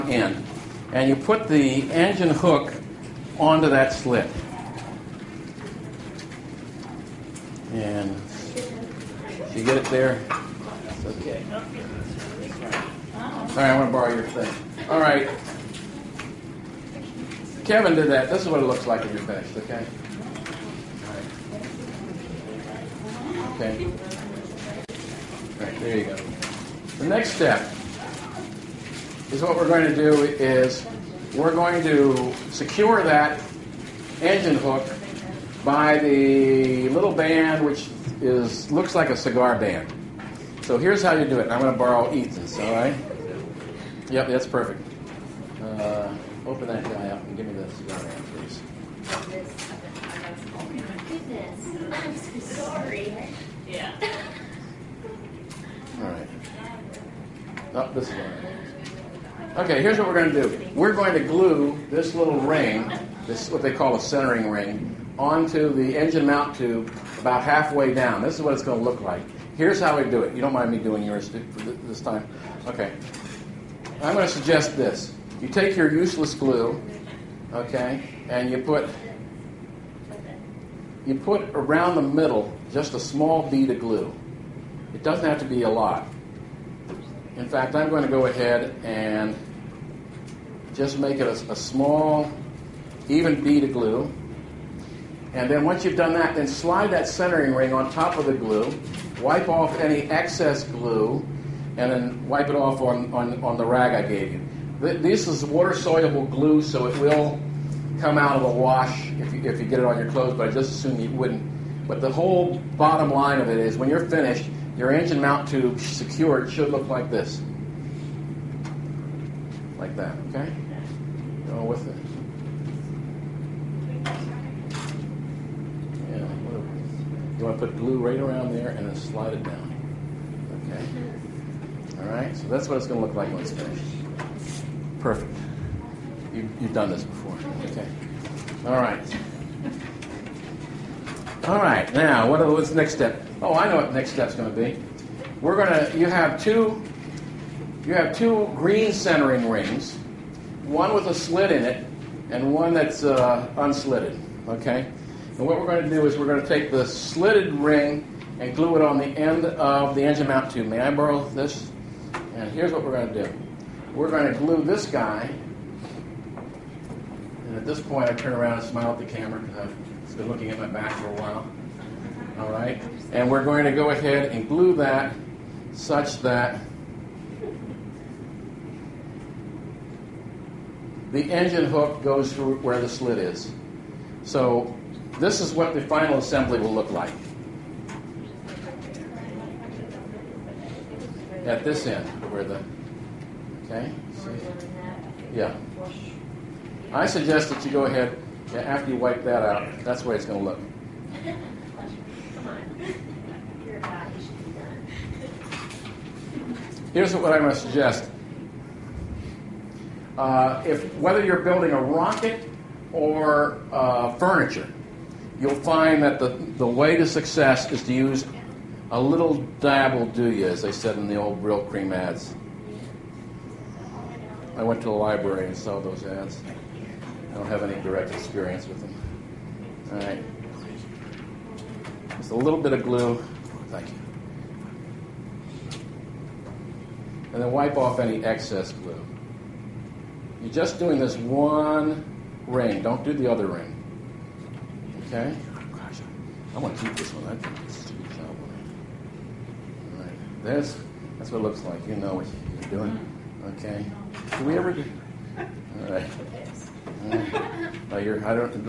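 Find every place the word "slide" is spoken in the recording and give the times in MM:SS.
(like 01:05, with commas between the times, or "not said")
01:36, 02:08.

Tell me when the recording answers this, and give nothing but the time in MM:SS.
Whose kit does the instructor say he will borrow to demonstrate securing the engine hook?
00:42.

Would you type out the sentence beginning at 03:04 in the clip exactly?
So this is what the final assembly will look like at this end where the okay.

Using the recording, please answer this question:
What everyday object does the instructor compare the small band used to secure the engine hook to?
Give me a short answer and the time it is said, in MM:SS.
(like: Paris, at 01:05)
A cigar band, at 00:39.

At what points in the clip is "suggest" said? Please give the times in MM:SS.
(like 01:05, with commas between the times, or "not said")
01:14, 03:17, 03:27.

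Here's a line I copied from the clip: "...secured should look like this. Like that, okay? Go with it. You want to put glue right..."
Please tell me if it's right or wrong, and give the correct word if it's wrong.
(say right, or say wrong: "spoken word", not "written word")
right.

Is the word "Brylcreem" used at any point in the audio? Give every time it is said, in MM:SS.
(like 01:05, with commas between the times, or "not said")
03:41.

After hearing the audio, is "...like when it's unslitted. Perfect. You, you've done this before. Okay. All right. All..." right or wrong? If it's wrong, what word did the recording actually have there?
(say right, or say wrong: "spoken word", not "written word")
wrong: "finished", not "unslitted".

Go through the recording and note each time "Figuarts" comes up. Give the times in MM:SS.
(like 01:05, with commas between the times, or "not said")
not said.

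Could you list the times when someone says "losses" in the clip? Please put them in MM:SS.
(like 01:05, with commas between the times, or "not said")
not said.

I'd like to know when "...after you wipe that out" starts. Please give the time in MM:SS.
03:18.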